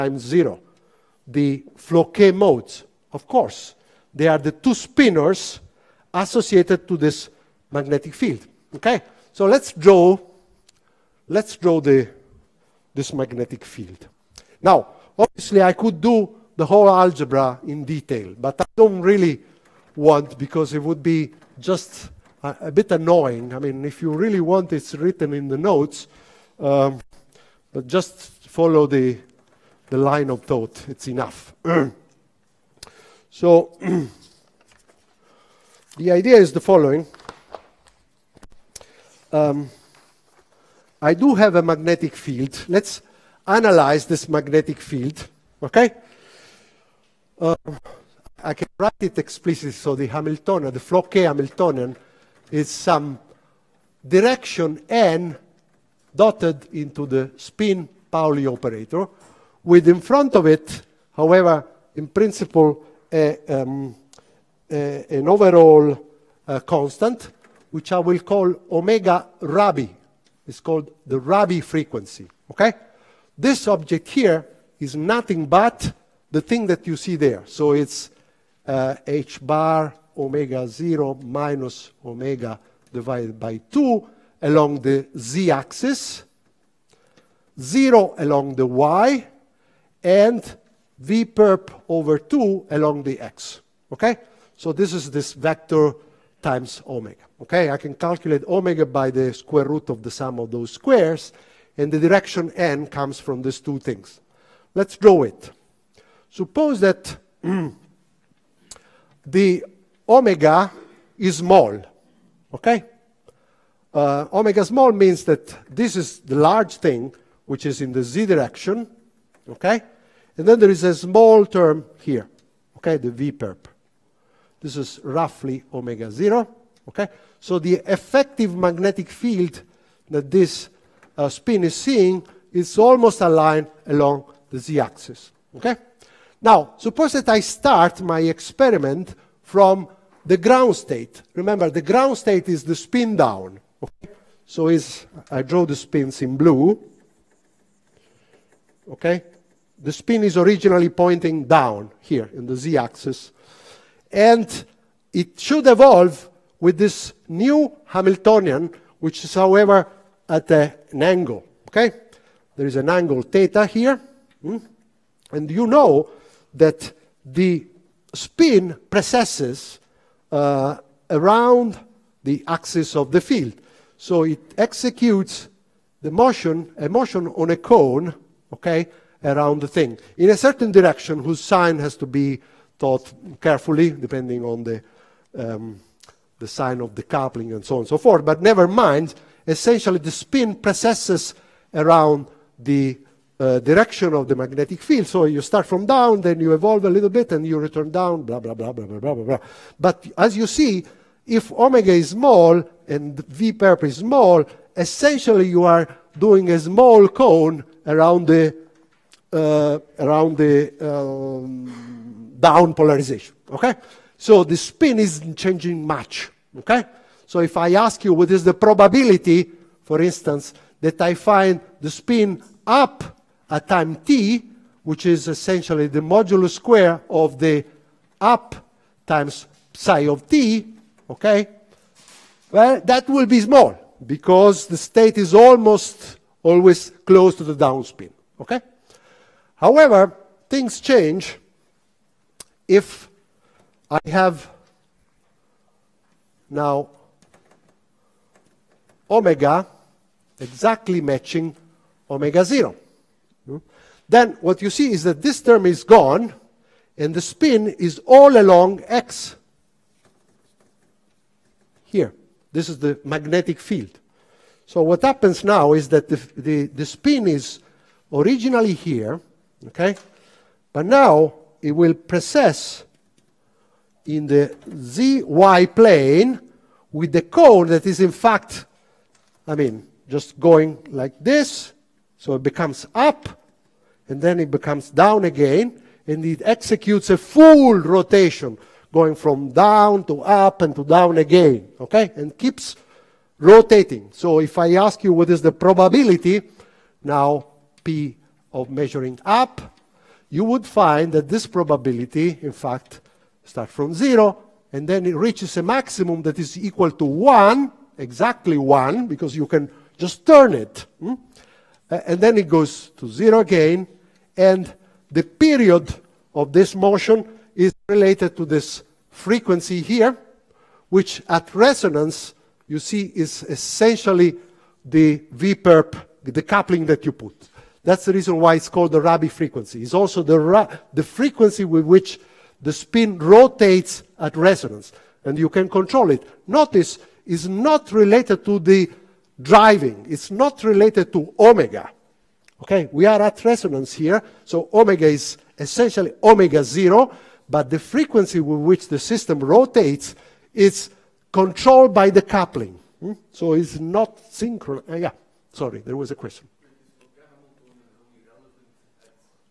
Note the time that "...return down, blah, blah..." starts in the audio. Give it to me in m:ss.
3:17.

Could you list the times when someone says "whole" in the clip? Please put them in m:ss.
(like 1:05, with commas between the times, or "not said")
0:16.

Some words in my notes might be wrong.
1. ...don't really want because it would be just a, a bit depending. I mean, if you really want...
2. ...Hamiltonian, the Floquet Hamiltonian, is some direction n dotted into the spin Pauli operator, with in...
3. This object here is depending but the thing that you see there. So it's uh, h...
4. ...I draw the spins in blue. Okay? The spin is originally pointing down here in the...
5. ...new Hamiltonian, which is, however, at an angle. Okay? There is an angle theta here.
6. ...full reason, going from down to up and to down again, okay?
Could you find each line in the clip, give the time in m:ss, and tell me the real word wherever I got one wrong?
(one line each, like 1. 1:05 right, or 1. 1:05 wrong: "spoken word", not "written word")
1. 0:18 wrong: "annoying", not "depending"
2. 0:50 right
3. 1:13 wrong: "nothing", not "depending"
4. 2:25 right
5. 2:37 right
6. 4:47 wrong: "rotation", not "reason".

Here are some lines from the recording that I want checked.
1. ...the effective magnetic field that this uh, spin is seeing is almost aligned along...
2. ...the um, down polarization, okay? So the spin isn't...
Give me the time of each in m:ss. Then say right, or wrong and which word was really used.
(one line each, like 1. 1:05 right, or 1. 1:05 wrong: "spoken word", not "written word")
1. 2:07 right
2. 3:30 right.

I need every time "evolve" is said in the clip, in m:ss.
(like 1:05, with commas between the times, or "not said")
2:35, 3:16.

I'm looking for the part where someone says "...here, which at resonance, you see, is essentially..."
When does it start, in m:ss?
5:19.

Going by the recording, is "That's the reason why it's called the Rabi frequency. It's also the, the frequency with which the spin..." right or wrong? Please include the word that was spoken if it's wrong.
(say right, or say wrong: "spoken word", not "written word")
right.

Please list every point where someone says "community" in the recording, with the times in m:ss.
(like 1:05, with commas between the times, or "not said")
not said.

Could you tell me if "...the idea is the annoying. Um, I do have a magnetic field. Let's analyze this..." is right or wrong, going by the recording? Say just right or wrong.
wrong.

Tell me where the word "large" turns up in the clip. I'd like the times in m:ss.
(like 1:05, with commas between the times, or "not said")
1:56.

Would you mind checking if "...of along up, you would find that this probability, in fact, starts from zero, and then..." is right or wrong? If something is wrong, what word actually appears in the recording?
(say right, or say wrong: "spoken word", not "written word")
wrong: "measuring", not "along".